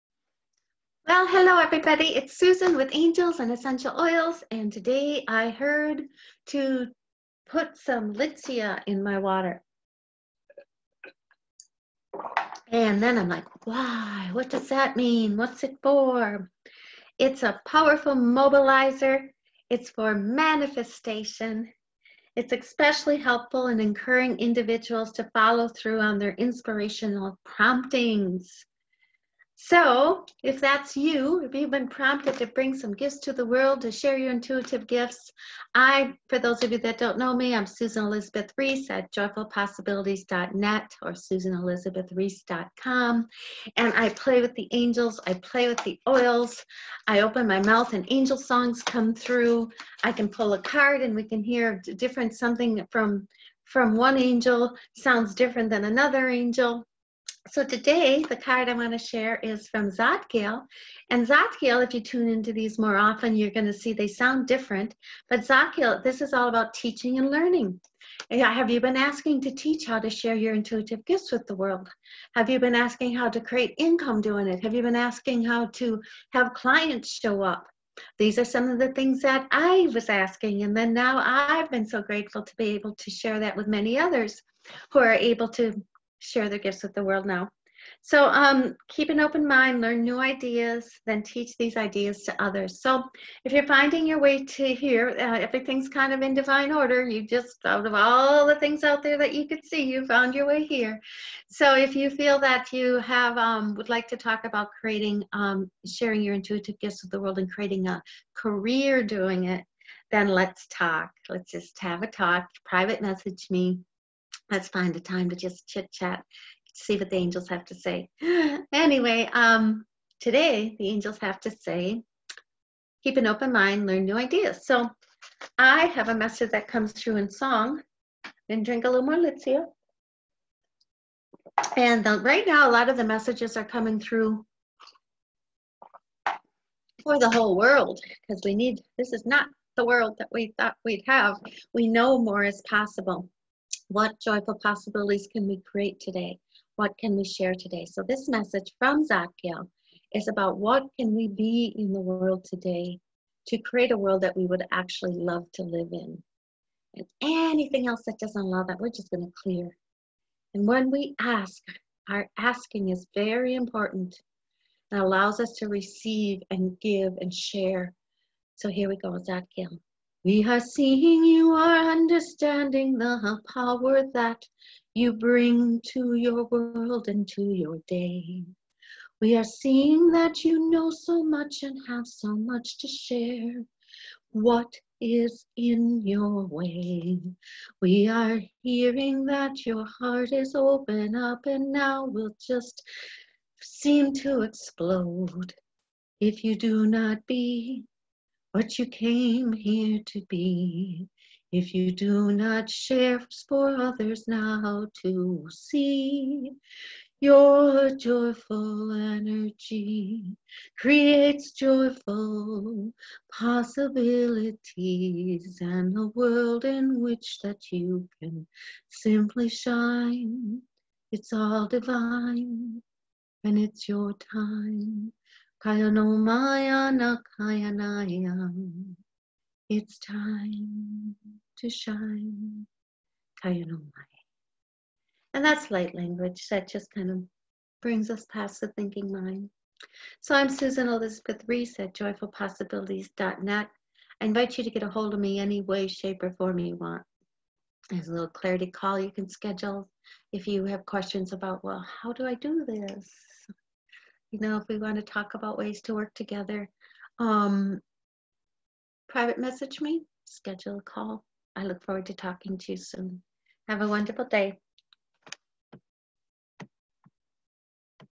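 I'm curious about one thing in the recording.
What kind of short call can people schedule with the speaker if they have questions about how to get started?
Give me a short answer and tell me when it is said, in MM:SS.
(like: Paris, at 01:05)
clarity call, at 04:08.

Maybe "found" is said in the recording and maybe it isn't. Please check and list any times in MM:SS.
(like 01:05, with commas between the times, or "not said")
01:40.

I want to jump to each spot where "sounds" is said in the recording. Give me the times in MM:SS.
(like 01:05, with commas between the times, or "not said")
00:54, 01:04.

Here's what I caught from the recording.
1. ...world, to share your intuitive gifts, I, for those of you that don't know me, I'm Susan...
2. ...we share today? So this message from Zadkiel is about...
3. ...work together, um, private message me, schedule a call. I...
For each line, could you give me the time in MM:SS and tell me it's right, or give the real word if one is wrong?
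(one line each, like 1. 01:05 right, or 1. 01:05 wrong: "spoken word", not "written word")
1. 00:33 right
2. 02:27 right
3. 04:15 right.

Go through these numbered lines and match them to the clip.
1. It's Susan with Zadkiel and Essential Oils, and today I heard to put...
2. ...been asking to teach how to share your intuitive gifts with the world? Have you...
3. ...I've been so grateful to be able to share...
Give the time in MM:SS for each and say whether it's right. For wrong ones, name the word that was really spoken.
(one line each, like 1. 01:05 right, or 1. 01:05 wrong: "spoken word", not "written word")
1. 00:02 wrong: "Angels", not "Zadkiel"
2. 01:08 right
3. 01:21 right.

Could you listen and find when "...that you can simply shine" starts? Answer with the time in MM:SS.
03:37.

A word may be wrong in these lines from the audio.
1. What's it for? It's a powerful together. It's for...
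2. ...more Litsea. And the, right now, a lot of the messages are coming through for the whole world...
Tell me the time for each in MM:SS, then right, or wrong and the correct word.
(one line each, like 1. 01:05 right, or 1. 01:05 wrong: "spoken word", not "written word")
1. 00:15 wrong: "mobilizer", not "together"
2. 02:09 right.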